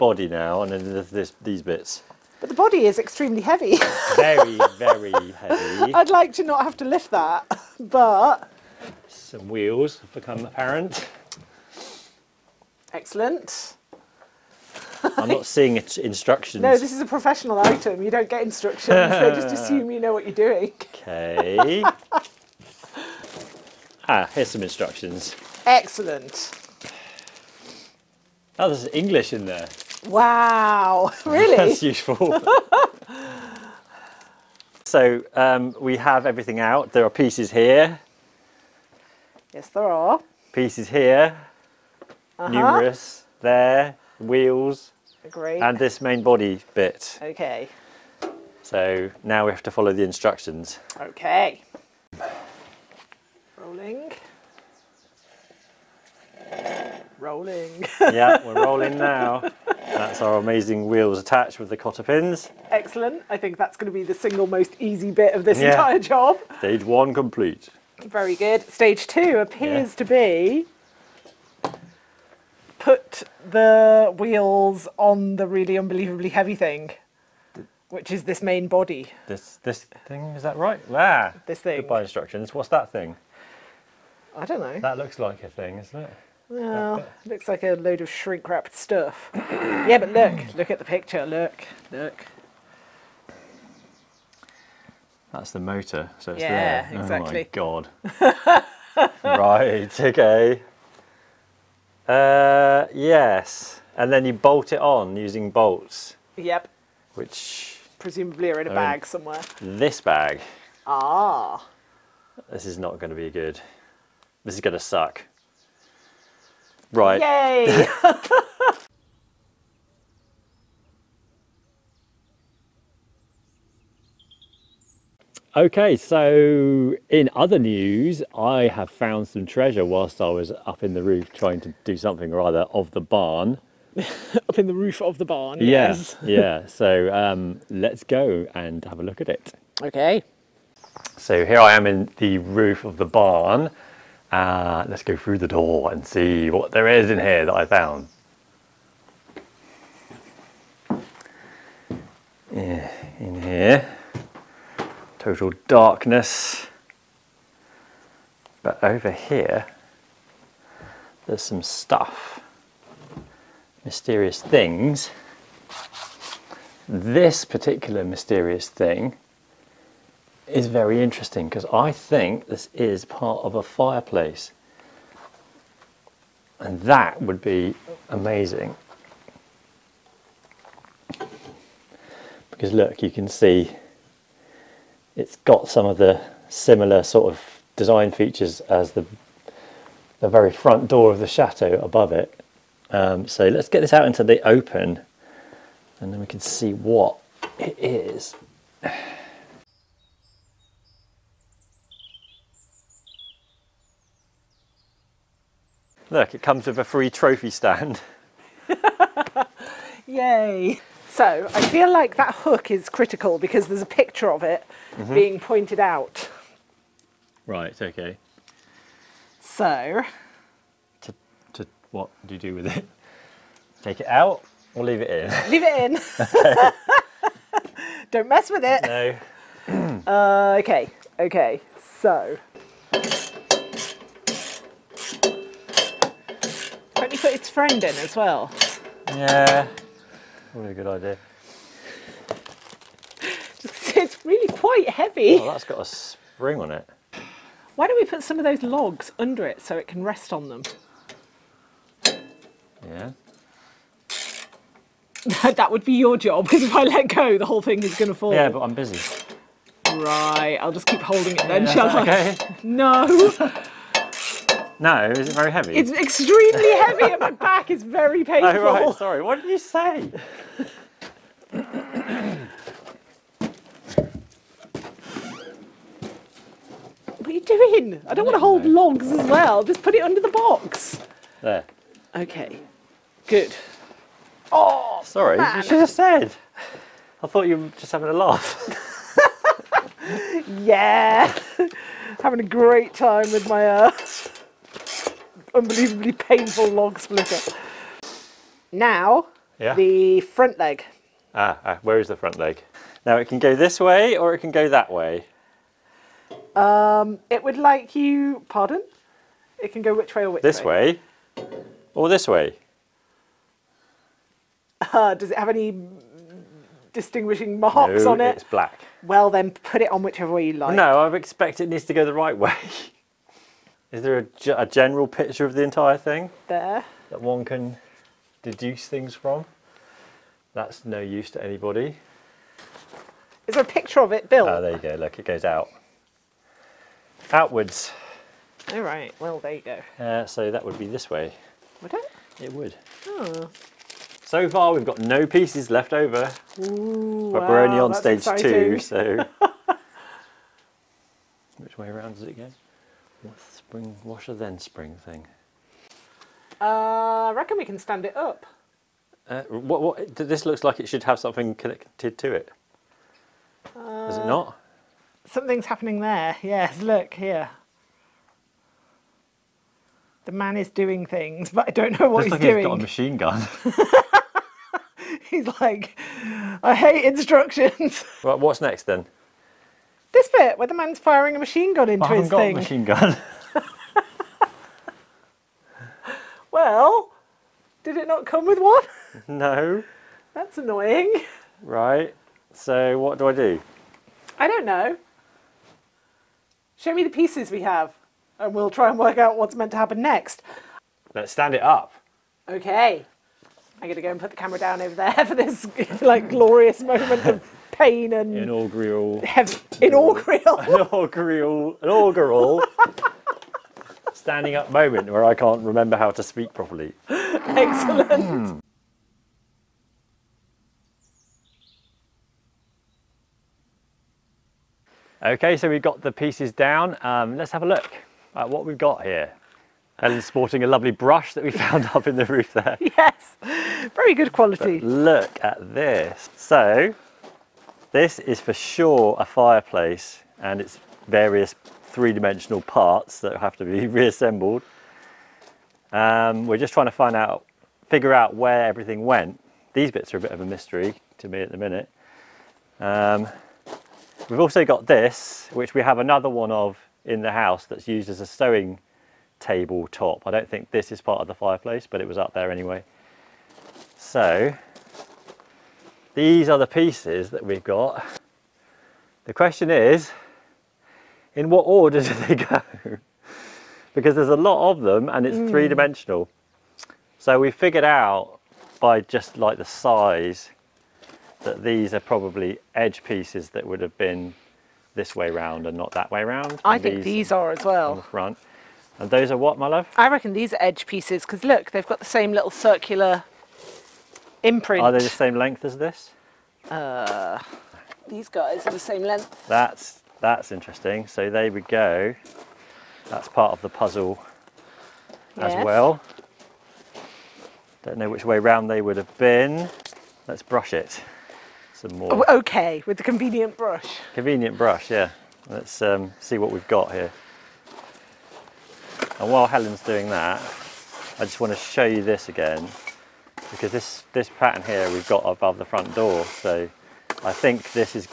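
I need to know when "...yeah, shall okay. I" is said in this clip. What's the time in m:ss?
4:21.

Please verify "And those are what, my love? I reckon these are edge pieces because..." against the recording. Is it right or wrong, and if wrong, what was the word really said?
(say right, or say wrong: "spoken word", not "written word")
right.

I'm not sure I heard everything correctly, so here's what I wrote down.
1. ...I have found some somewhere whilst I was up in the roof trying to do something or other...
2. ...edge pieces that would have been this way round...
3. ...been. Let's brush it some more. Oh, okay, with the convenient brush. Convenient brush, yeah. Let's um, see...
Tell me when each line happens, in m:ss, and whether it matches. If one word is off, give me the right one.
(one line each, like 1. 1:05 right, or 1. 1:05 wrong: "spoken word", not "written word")
1. 2:08 wrong: "treasure", not "somewhere"
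2. 8:02 right
3. 8:29 right.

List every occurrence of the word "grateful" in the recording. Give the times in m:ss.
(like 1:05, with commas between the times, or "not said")
not said.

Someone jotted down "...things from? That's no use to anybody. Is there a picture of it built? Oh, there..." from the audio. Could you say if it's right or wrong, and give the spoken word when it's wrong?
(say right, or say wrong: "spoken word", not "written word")
right.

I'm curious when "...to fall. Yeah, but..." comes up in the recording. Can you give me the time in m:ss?
4:18.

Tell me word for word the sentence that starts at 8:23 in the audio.
That's part of the puzzle yes.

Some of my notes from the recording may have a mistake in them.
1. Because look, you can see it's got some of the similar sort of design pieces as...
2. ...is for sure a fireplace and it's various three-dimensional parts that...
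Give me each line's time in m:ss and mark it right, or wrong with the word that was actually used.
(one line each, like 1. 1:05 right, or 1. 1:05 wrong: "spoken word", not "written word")
1. 3:02 wrong: "features", not "pieces"
2. 7:18 right.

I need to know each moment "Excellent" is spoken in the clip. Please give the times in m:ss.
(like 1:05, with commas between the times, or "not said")
0:12, 0:25, 1:02, 6:57.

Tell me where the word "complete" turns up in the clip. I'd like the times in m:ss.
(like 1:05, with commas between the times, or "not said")
1:07.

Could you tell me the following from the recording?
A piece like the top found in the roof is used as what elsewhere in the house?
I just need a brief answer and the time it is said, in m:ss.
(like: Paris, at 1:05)
a sewing table top, at 7:38.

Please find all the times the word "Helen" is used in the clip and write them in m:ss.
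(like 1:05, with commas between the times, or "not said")
7:09, 8:39.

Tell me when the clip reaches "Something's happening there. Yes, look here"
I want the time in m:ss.
6:05.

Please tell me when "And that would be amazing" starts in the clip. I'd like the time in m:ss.
2:56.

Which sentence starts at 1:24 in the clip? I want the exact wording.
That looks like a thing, isn't it?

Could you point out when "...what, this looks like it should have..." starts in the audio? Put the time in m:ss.
5:59.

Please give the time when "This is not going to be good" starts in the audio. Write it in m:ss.
1:52.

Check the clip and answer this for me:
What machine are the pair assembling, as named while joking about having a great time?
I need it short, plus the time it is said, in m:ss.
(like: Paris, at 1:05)
log splitter, at 4:56.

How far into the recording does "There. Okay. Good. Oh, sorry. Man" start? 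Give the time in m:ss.
4:41.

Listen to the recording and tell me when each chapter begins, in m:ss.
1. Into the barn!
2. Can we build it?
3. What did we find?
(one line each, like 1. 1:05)
1. 2:02
2. 3:21
3. 6:59.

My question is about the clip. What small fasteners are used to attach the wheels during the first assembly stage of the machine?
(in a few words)
cotter pins.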